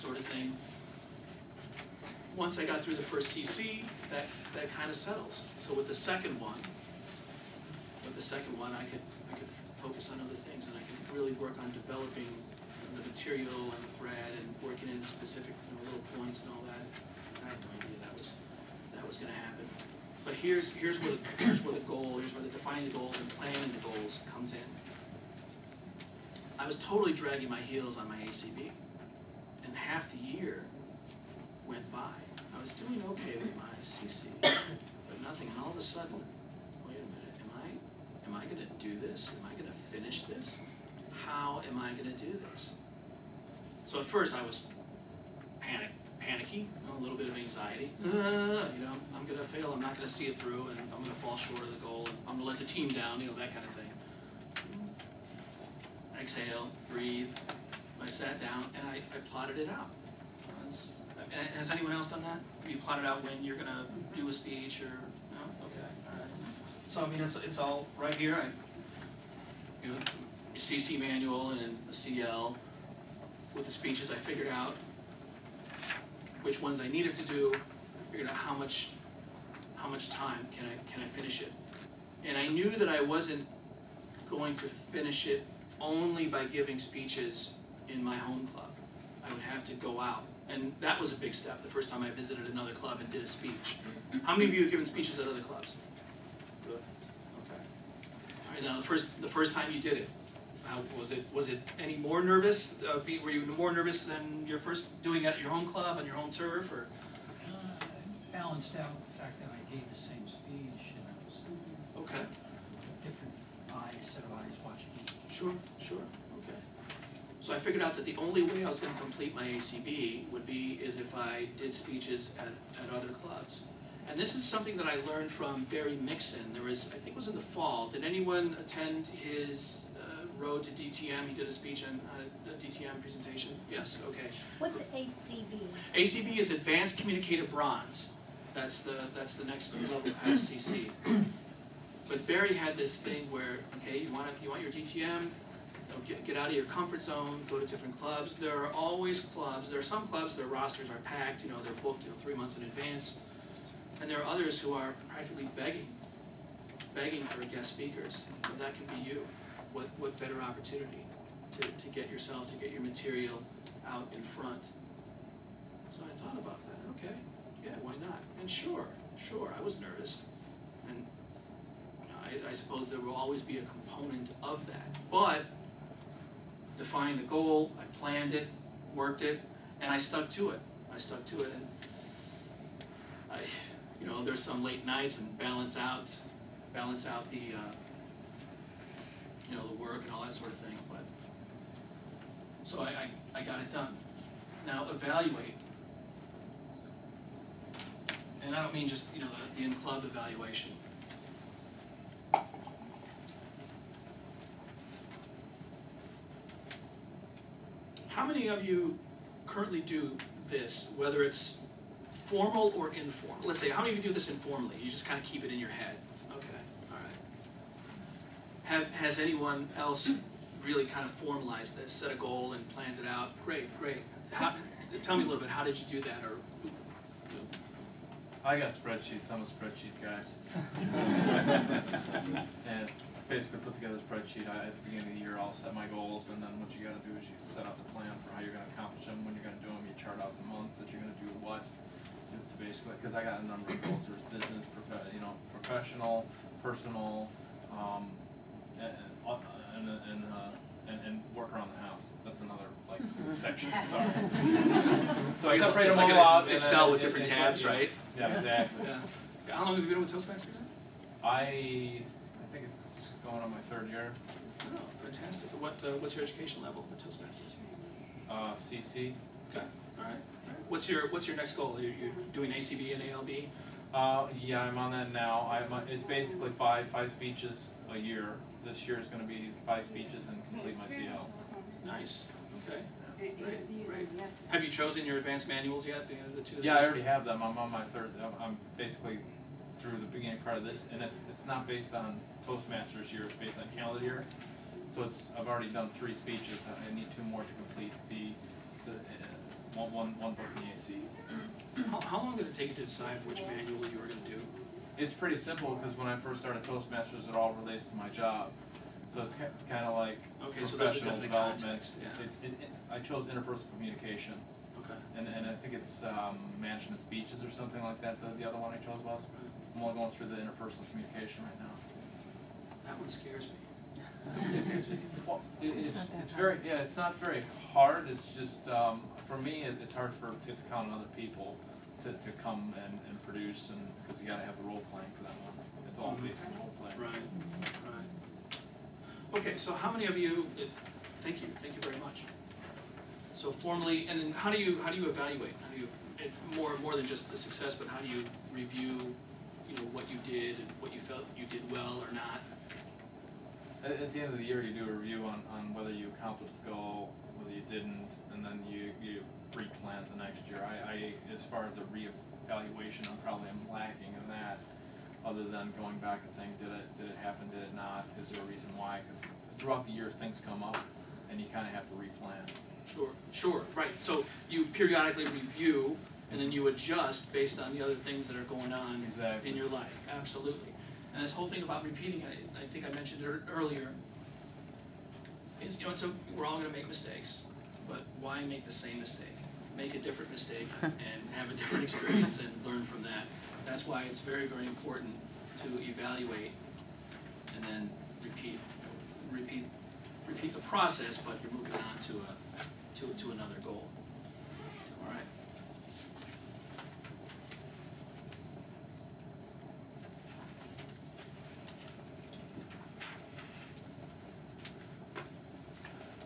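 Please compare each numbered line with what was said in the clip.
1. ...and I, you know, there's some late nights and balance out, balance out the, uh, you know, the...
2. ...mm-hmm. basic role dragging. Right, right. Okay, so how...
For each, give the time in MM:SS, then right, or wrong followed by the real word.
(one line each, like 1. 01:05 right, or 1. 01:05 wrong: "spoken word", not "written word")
1. 03:01 right
2. 05:36 wrong: "playing", not "dragging".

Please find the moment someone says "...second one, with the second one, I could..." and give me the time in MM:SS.
00:05.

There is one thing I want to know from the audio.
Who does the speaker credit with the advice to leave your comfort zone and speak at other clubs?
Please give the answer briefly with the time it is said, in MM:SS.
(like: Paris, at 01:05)
Barry Mixon, at 02:05.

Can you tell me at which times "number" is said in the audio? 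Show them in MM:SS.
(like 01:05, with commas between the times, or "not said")
04:03.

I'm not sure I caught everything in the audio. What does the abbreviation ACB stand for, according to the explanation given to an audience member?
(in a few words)
Advanced Communicative Bronze.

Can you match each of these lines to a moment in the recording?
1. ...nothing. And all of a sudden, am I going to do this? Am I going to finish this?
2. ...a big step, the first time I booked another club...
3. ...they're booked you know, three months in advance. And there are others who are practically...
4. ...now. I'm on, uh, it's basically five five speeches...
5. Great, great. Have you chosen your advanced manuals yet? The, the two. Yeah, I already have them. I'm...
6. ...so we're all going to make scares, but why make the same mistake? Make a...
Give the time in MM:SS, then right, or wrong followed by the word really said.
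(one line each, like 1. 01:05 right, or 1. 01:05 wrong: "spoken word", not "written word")
1. 00:35 right
2. 01:31 wrong: "visited", not "booked"
3. 02:31 right
4. 04:35 right
5. 04:43 right
6. 06:25 wrong: "mistakes", not "scares".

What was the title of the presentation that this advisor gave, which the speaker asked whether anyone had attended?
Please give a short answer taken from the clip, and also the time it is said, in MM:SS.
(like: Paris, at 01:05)
Road to DTM, at 02:10.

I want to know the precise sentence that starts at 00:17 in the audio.
I had no idea that was that was going to happen.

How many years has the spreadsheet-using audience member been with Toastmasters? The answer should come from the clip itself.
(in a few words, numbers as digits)
3.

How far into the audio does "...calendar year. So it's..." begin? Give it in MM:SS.
04:53.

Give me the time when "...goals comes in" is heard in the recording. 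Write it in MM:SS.
00:23.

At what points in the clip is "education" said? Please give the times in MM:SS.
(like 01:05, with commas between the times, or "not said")
04:26.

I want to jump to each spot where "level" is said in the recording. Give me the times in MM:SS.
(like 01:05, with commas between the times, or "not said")
02:19, 04:26.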